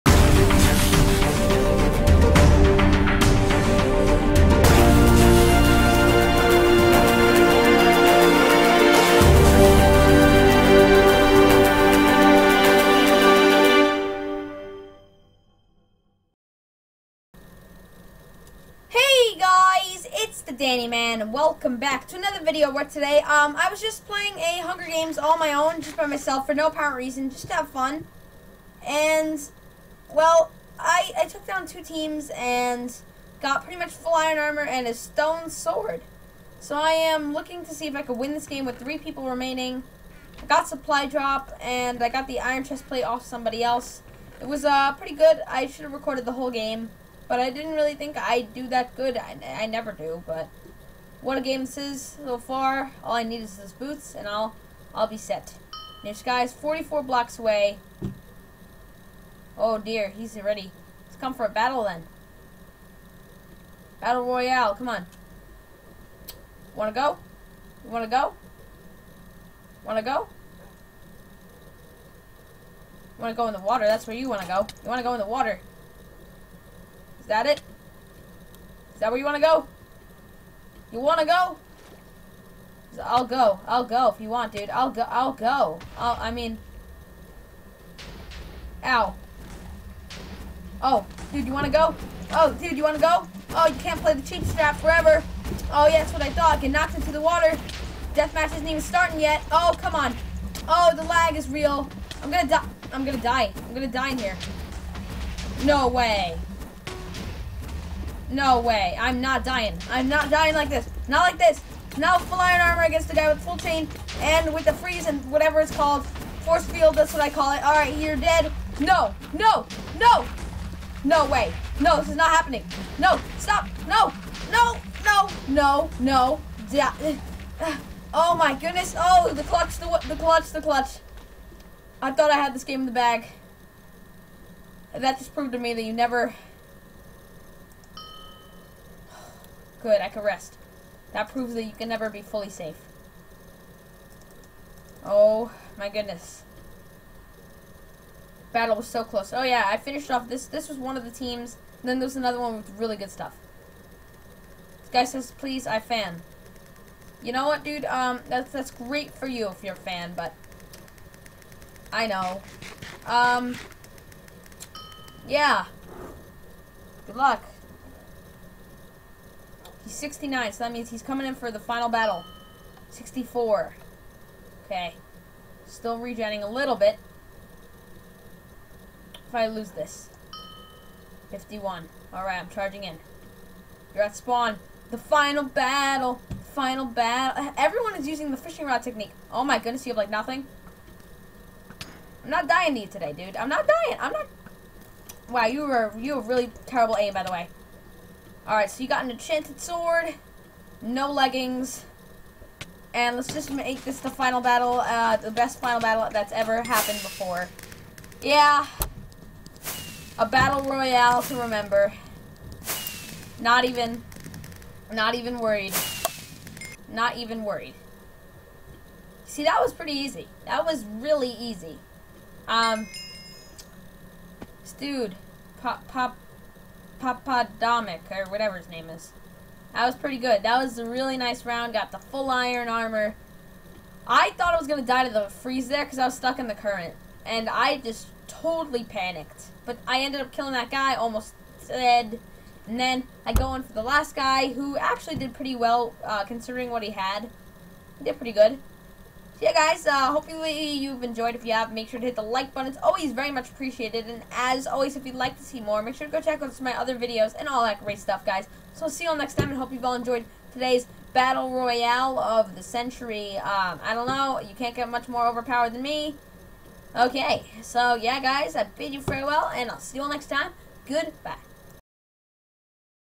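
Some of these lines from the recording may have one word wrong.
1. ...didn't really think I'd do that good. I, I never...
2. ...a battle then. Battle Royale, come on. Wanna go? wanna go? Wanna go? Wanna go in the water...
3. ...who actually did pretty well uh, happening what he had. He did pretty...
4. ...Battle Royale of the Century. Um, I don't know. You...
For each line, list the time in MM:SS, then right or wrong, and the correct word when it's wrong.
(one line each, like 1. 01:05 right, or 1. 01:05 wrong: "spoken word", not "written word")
1. 00:47 right
2. 01:01 right
3. 04:04 wrong: "considering", not "happening"
4. 04:21 right.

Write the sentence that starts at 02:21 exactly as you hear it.
That proves that you can never be fully safe.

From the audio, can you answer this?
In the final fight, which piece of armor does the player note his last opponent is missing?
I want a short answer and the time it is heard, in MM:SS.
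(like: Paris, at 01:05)
leggings, at 03:20.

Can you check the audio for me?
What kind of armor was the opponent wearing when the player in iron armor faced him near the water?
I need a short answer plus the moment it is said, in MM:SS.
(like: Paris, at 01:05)
full chain, at 01:53.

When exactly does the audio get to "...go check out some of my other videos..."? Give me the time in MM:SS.
04:16.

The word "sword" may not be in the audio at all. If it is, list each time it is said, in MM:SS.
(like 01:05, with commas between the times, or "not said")
00:35, 03:19.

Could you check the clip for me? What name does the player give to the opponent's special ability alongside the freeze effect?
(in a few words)
Force field.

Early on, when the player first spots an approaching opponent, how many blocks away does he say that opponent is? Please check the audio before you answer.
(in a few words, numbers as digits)
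44.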